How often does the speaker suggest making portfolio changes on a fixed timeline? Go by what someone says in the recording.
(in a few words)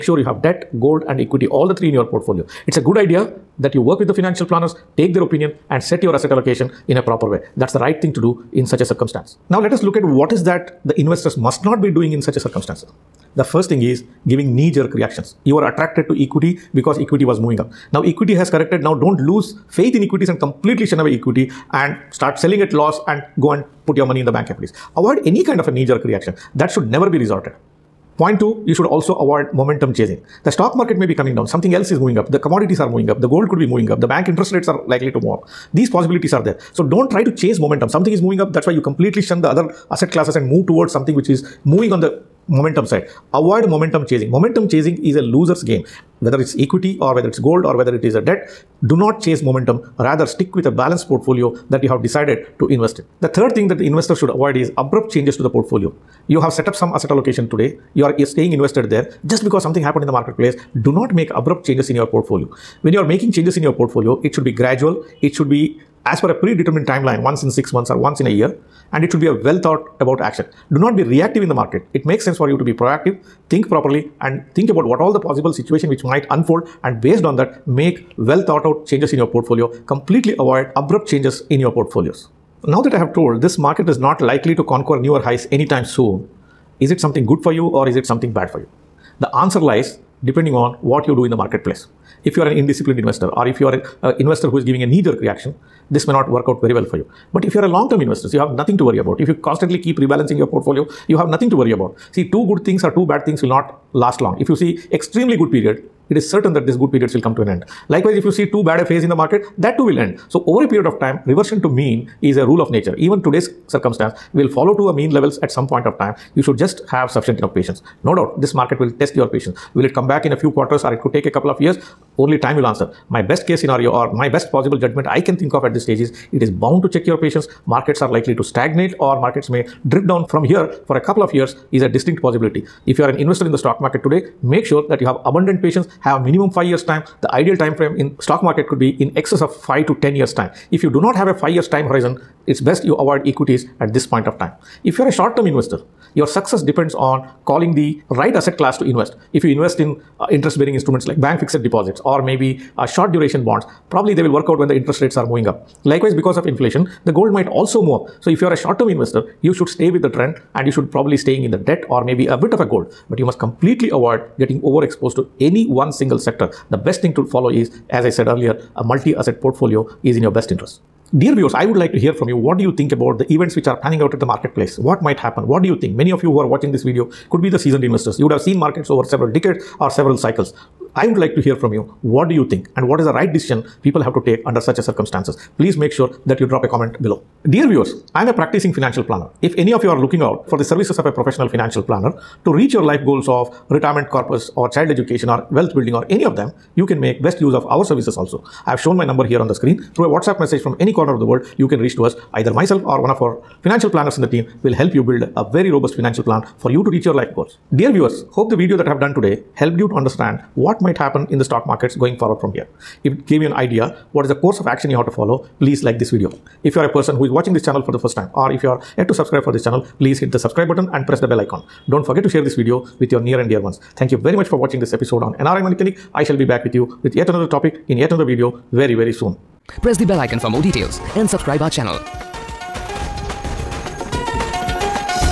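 Once in six months.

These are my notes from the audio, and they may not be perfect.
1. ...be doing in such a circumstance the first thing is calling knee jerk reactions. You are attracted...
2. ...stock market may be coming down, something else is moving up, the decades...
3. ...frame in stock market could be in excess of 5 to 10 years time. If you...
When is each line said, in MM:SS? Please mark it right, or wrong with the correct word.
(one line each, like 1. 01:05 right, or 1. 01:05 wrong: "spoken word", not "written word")
1. 00:11 wrong: "giving", not "calling"
2. 00:30 wrong: "commodities", not "decades"
3. 02:17 right.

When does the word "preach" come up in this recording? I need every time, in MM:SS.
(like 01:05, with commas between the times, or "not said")
not said.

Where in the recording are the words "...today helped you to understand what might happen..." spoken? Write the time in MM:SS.
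03:29.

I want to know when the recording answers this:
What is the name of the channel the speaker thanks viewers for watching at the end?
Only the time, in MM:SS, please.
03:45.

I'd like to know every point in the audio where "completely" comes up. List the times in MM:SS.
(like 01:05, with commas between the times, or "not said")
00:20, 00:38, 01:19, 02:43.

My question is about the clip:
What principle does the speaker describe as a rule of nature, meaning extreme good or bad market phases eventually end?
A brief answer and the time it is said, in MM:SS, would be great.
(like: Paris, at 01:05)
Reversion to mean, at 01:51.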